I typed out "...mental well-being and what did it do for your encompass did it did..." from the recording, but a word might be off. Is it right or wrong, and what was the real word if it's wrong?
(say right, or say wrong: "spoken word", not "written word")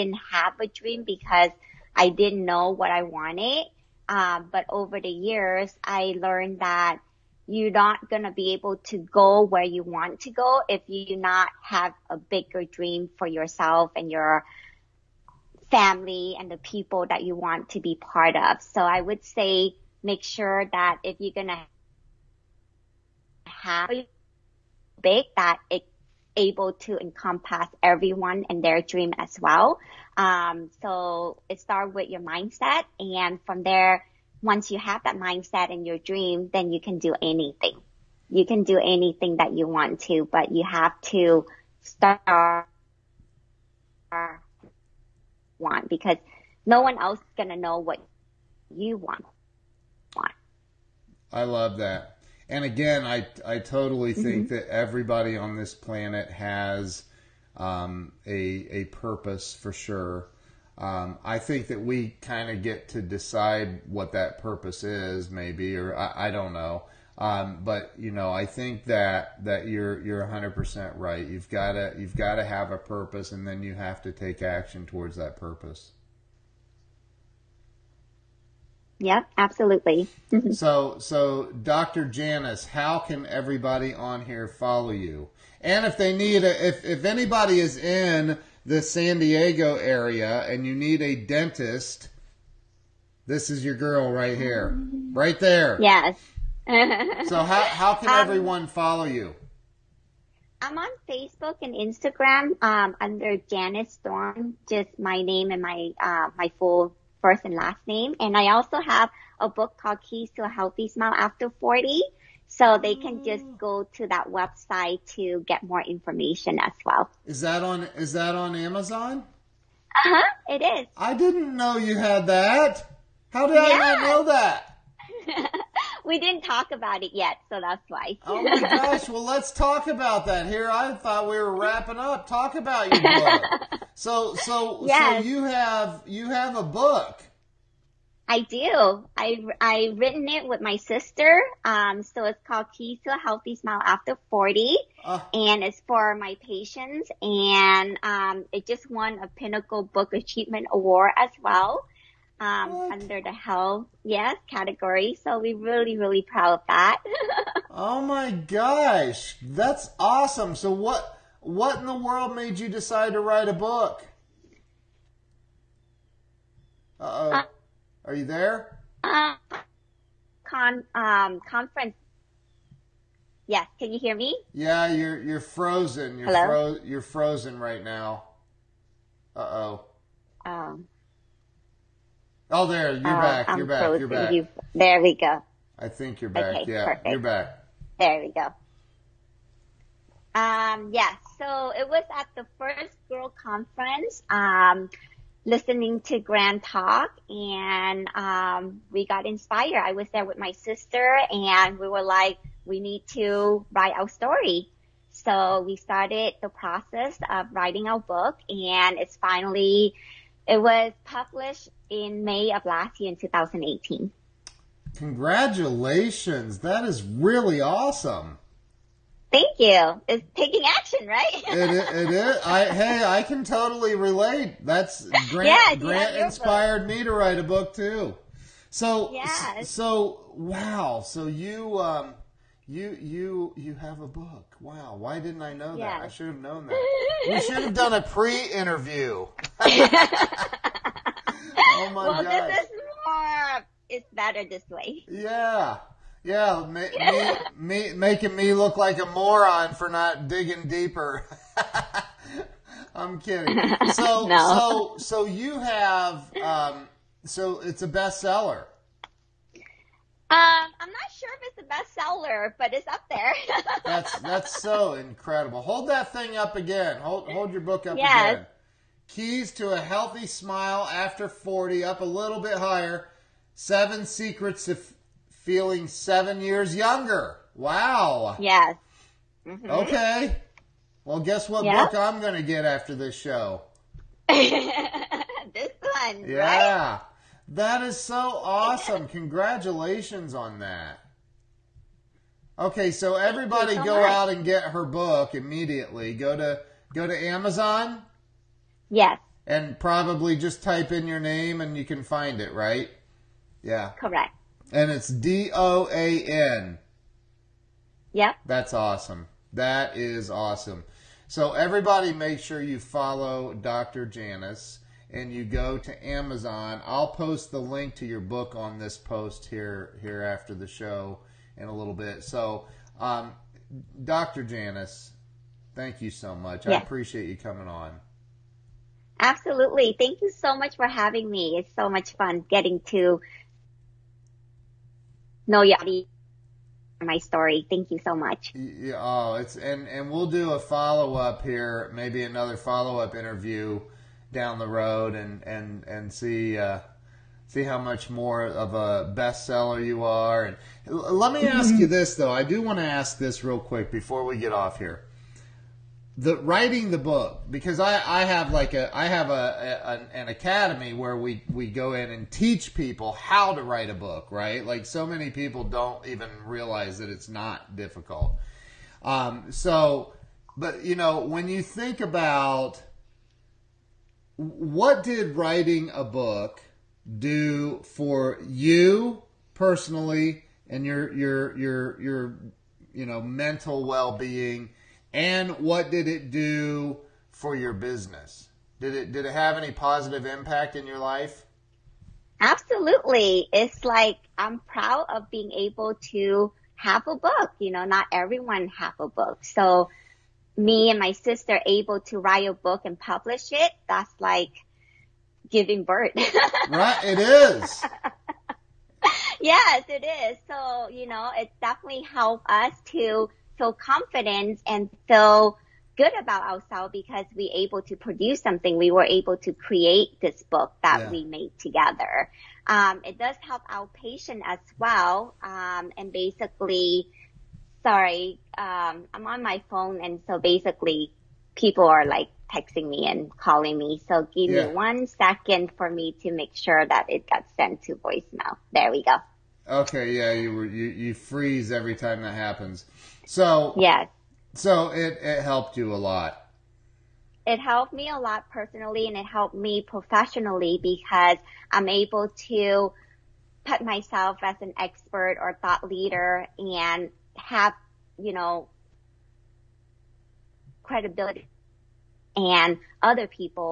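wrong: "business", not "encompass".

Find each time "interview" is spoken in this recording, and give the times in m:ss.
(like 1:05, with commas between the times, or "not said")
3:58, 5:43.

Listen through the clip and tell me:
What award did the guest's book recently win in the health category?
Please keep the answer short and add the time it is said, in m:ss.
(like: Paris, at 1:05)
Pinnacle Book Achievement Award, at 2:29.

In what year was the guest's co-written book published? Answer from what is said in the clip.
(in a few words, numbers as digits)
2018.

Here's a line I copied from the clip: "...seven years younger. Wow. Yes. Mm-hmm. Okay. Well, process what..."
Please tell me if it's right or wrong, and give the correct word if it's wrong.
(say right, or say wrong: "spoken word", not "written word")
wrong: "guess", not "process".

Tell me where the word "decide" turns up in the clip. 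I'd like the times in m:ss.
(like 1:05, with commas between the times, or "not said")
1:03, 2:42.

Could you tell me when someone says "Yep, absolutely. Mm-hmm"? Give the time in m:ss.
1:18.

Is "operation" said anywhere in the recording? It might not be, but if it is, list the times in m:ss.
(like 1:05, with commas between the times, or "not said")
not said.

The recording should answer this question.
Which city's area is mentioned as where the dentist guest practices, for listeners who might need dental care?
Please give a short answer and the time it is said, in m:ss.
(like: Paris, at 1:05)
San Diego, at 1:28.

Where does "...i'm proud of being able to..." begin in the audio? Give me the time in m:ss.
6:34.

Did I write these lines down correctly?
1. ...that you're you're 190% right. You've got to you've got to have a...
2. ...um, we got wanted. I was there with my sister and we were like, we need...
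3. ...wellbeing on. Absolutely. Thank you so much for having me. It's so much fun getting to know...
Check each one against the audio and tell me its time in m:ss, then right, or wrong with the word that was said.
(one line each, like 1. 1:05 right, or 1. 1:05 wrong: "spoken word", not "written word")
1. 1:09 wrong: "100", not "190"
2. 3:18 wrong: "inspired", not "wanted"
3. 5:27 wrong: "coming", not "wellbeing".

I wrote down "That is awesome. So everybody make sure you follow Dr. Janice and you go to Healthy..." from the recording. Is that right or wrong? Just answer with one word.
wrong.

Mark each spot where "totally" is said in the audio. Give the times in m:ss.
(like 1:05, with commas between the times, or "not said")
0:53, 3:43.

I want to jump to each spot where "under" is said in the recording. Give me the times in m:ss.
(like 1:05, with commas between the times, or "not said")
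1:43, 2:32.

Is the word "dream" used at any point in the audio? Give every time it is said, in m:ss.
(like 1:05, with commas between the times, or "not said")
0:00, 0:12, 0:28, 0:35.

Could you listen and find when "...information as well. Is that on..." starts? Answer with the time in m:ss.
1:55.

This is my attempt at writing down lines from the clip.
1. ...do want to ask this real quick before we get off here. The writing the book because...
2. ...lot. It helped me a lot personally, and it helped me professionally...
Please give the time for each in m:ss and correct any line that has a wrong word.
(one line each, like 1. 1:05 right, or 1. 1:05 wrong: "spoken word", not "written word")
1. 5:52 right
2. 7:26 right.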